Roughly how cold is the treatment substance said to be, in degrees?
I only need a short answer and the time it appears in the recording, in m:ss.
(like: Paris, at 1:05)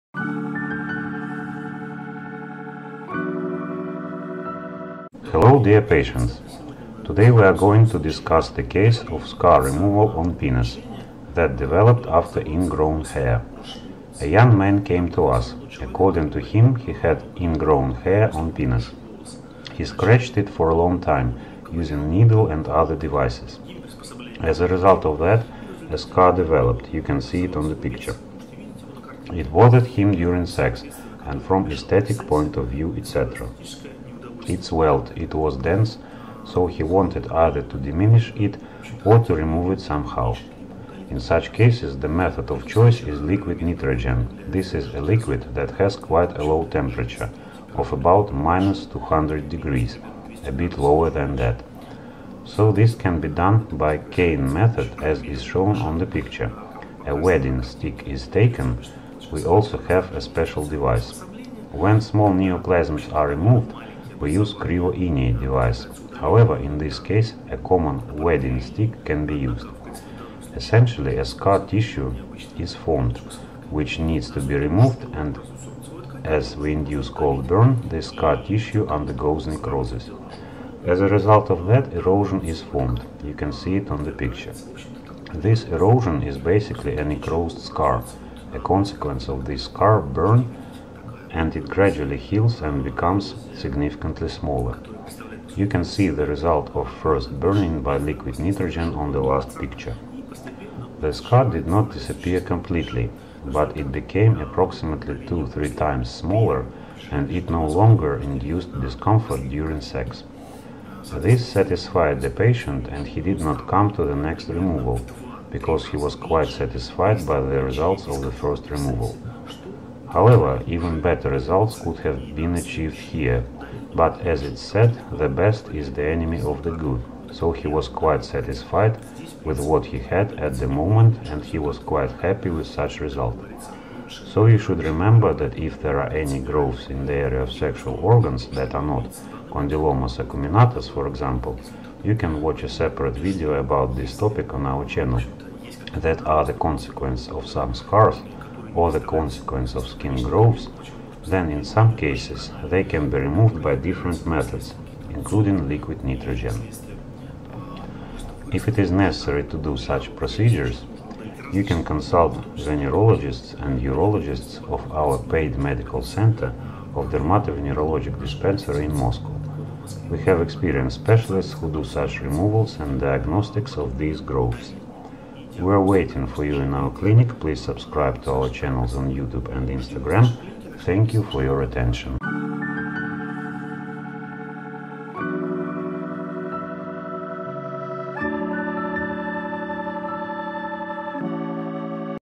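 -200, at 0:48.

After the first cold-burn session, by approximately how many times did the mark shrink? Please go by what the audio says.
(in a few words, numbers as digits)
2-3 times.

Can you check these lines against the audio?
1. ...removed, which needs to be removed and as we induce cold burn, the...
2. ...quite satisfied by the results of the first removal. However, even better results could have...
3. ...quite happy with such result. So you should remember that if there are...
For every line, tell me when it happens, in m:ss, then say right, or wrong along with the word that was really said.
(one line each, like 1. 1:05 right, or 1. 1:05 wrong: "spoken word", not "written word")
1. 1:12 wrong: "formed", not "removed"
2. 1:56 right
3. 2:11 right.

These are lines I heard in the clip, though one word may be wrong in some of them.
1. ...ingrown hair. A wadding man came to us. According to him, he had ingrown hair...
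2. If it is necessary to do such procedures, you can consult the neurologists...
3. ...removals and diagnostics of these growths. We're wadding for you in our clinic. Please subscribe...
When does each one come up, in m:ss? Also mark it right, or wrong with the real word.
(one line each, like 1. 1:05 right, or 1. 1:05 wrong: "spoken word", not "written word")
1. 0:12 wrong: "young", not "wadding"
2. 2:38 right
3. 2:52 wrong: "waiting", not "wadding".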